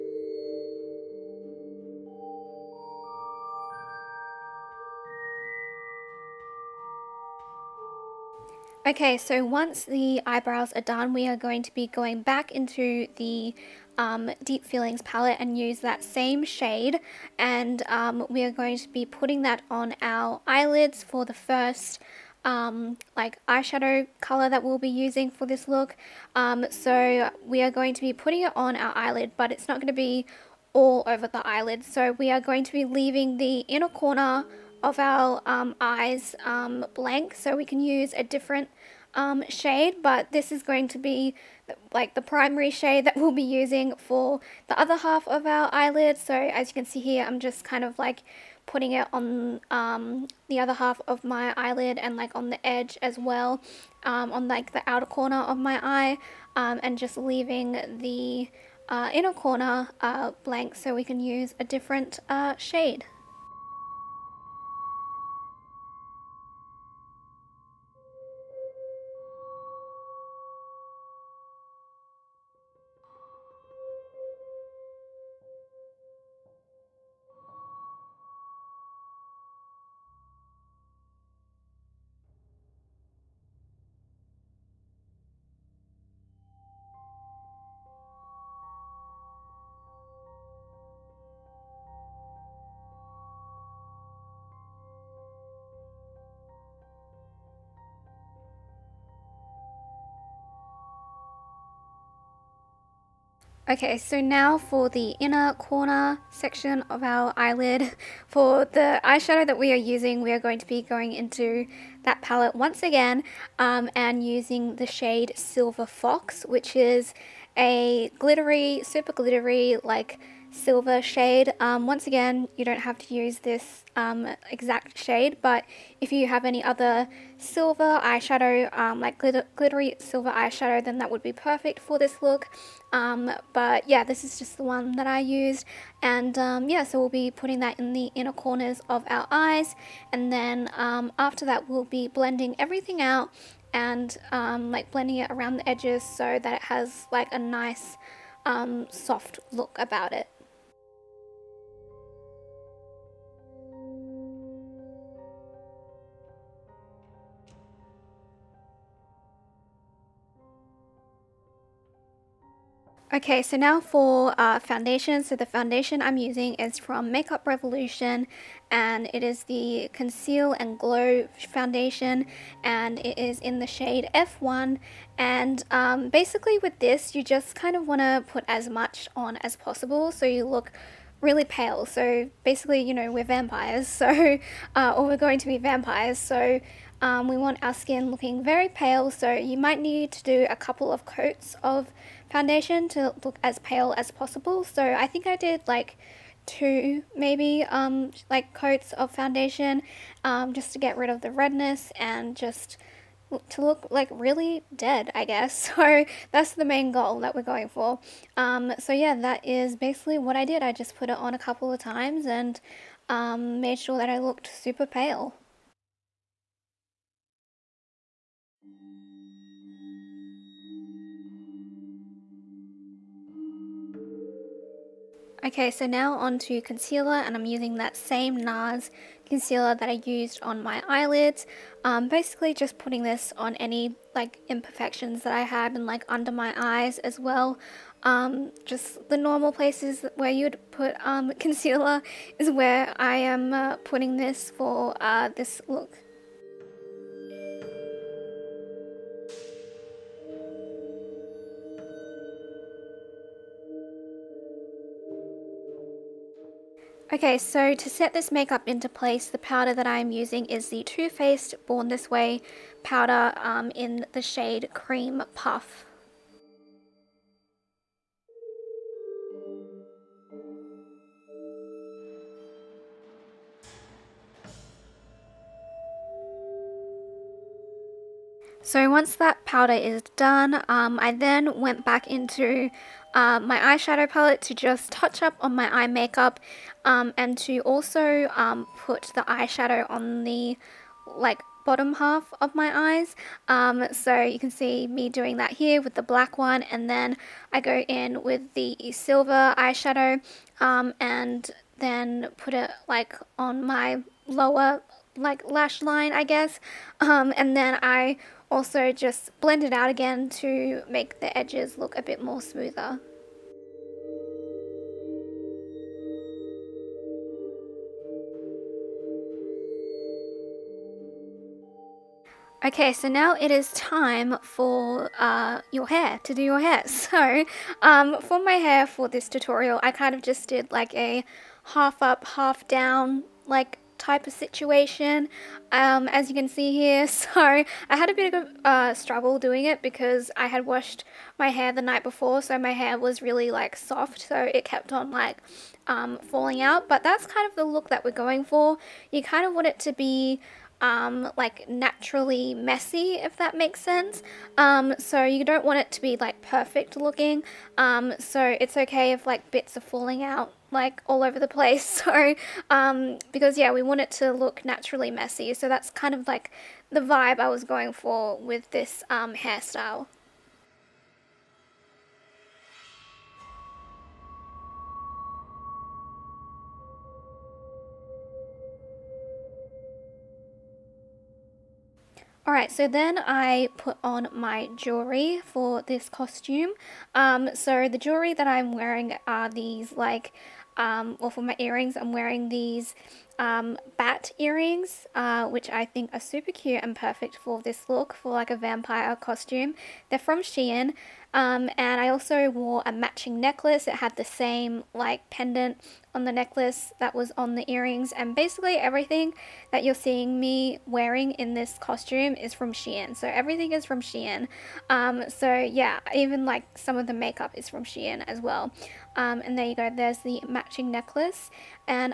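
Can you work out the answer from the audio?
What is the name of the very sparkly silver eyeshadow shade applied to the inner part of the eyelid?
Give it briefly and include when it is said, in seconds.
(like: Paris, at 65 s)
Silver Fox, at 115 s.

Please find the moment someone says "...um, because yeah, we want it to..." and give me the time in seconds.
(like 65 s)
362 s.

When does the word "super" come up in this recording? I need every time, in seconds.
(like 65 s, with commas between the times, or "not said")
118 s, 214 s, 396 s.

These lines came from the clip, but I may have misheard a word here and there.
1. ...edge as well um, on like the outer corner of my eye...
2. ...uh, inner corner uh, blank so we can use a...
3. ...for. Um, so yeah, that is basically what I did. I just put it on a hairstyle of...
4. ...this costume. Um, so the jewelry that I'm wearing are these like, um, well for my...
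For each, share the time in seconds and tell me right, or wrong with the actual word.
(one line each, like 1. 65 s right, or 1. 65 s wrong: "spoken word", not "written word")
1. 52 s right
2. 58 s right
3. 207 s wrong: "couple", not "hairstyle"
4. 385 s right.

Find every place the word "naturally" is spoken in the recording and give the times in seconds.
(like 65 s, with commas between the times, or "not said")
351 s, 364 s.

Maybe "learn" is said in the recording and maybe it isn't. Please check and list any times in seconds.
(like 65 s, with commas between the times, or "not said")
not said.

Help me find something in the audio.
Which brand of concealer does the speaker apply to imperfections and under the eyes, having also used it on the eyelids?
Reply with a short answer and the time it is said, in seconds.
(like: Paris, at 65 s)
NARS, at 228 s.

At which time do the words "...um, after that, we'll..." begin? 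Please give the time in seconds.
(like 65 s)
140 s.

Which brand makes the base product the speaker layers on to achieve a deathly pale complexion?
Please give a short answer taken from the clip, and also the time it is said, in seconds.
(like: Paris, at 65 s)
Makeup Revolution, at 167 s.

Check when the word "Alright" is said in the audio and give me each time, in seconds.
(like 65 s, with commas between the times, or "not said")
382 s.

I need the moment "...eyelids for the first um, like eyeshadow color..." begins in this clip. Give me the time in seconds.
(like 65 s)
20 s.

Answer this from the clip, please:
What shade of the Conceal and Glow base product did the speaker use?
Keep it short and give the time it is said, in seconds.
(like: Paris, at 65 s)
F1, at 174 s.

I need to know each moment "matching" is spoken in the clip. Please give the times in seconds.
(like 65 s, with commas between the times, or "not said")
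402 s, 420 s.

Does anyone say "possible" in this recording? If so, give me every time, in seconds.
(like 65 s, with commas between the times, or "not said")
179 s, 194 s.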